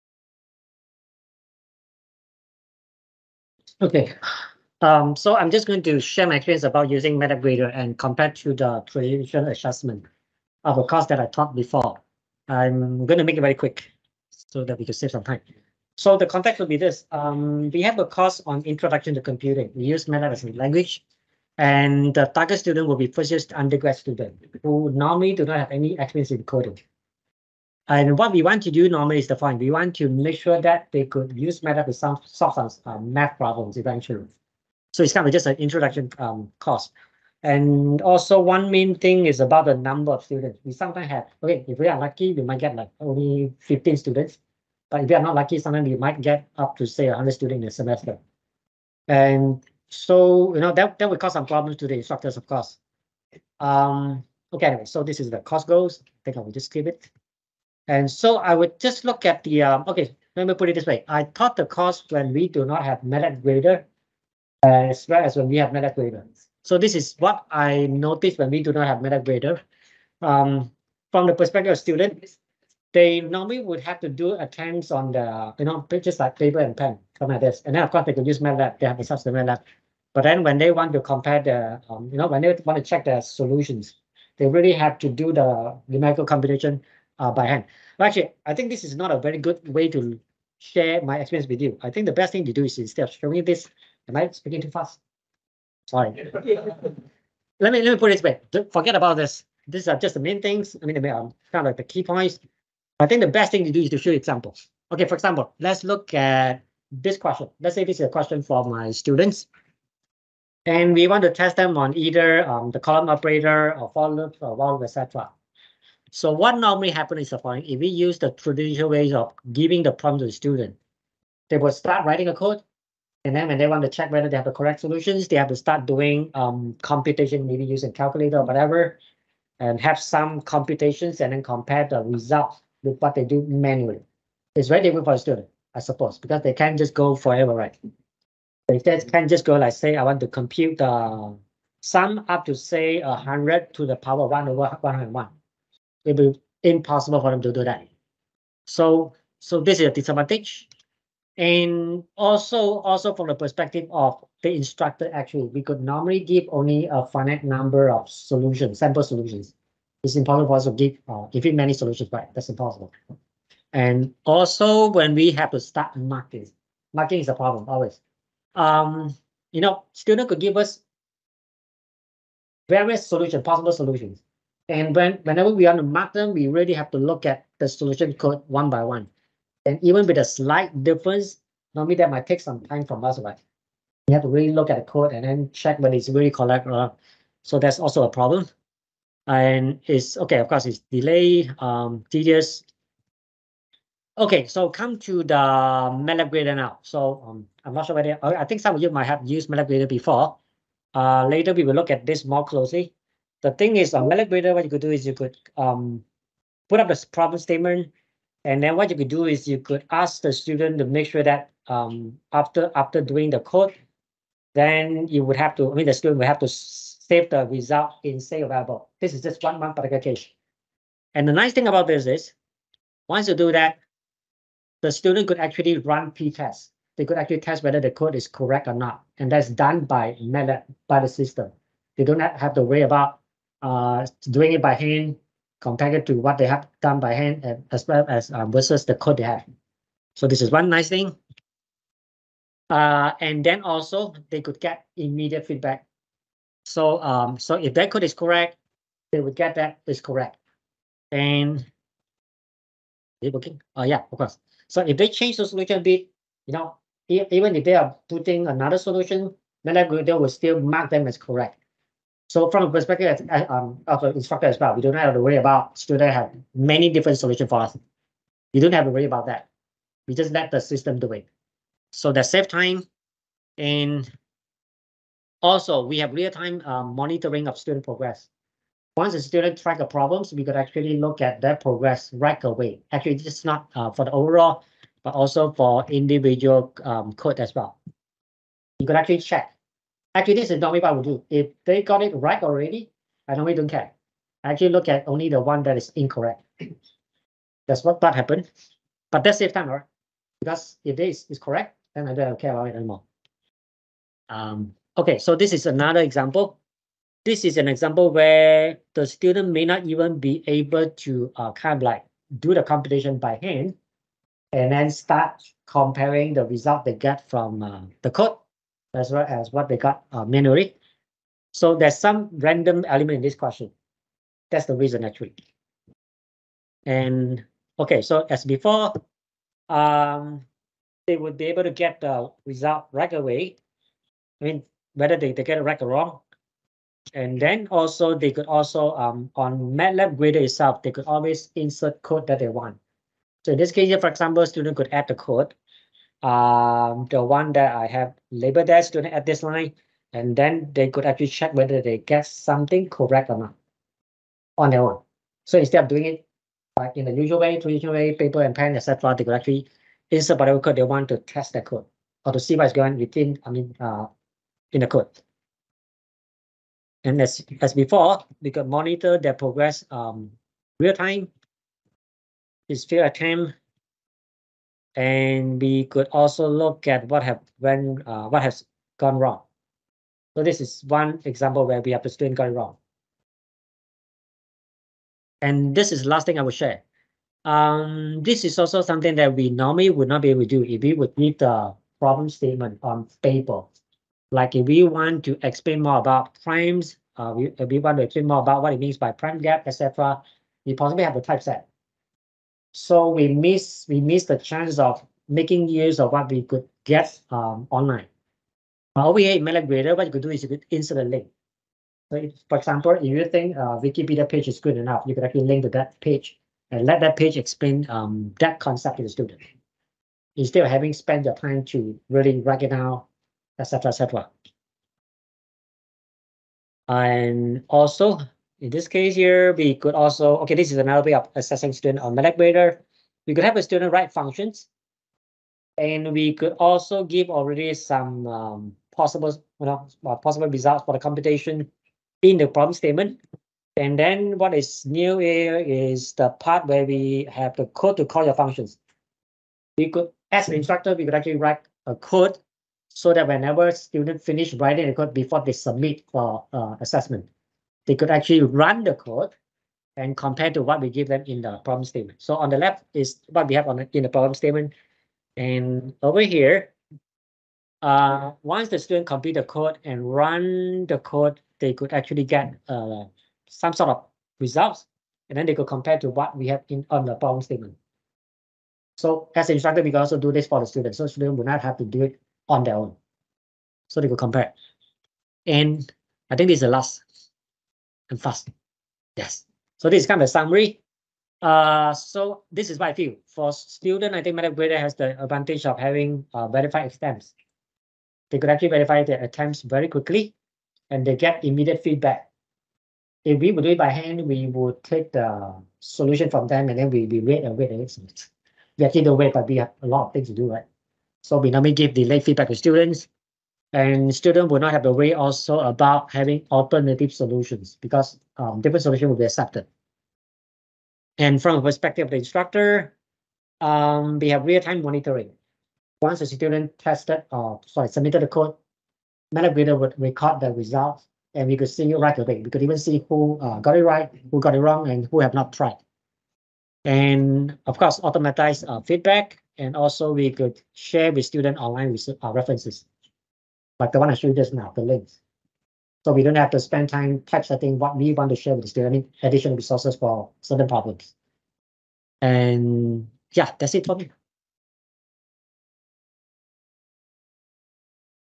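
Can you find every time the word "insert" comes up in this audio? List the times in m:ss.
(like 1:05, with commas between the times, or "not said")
5:41, 6:00, 6:50.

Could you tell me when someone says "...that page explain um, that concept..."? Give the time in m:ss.
6:57.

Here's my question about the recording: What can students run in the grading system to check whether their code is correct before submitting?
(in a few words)
pretest.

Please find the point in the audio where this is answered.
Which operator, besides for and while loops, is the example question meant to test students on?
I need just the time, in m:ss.
1:52.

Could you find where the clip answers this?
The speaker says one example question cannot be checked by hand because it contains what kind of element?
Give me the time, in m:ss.
5:22.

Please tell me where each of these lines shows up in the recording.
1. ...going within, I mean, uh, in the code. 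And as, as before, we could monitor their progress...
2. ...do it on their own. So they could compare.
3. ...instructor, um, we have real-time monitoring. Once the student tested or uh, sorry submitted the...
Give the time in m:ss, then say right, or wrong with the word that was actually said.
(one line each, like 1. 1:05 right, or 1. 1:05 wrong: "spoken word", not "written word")
1. 6:02 right
2. 8:01 right
3. 8:42 right.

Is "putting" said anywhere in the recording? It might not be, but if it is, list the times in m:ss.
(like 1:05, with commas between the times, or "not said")
4:18.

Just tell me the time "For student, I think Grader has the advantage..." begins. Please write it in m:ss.
8:13.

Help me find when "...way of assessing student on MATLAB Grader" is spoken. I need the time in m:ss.
7:11.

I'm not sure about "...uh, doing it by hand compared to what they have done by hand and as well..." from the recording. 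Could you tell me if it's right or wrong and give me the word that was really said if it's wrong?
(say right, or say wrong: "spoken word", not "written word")
right.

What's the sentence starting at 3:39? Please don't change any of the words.
This is just one, one particular case.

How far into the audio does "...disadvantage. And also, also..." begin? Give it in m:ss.
2:29.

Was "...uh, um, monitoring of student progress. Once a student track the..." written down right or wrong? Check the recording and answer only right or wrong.
right.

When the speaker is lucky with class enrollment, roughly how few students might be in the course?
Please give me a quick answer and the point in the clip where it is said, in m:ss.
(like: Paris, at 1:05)
15, at 0:43.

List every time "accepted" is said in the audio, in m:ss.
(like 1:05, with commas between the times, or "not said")
8:39.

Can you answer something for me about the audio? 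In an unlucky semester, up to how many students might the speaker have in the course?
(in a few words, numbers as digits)
100.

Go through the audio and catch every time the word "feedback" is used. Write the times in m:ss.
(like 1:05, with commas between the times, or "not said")
4:05, 8:21, 8:32, 8:58.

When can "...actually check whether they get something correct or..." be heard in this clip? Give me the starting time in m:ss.
5:51.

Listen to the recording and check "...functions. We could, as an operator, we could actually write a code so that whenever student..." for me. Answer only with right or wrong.
wrong.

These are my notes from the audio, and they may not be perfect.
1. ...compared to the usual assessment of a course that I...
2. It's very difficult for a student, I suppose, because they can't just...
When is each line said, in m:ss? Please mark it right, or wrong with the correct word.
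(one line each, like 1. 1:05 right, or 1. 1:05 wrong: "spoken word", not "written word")
1. 0:07 wrong: "traditional", not "usual"
2. 2:14 right.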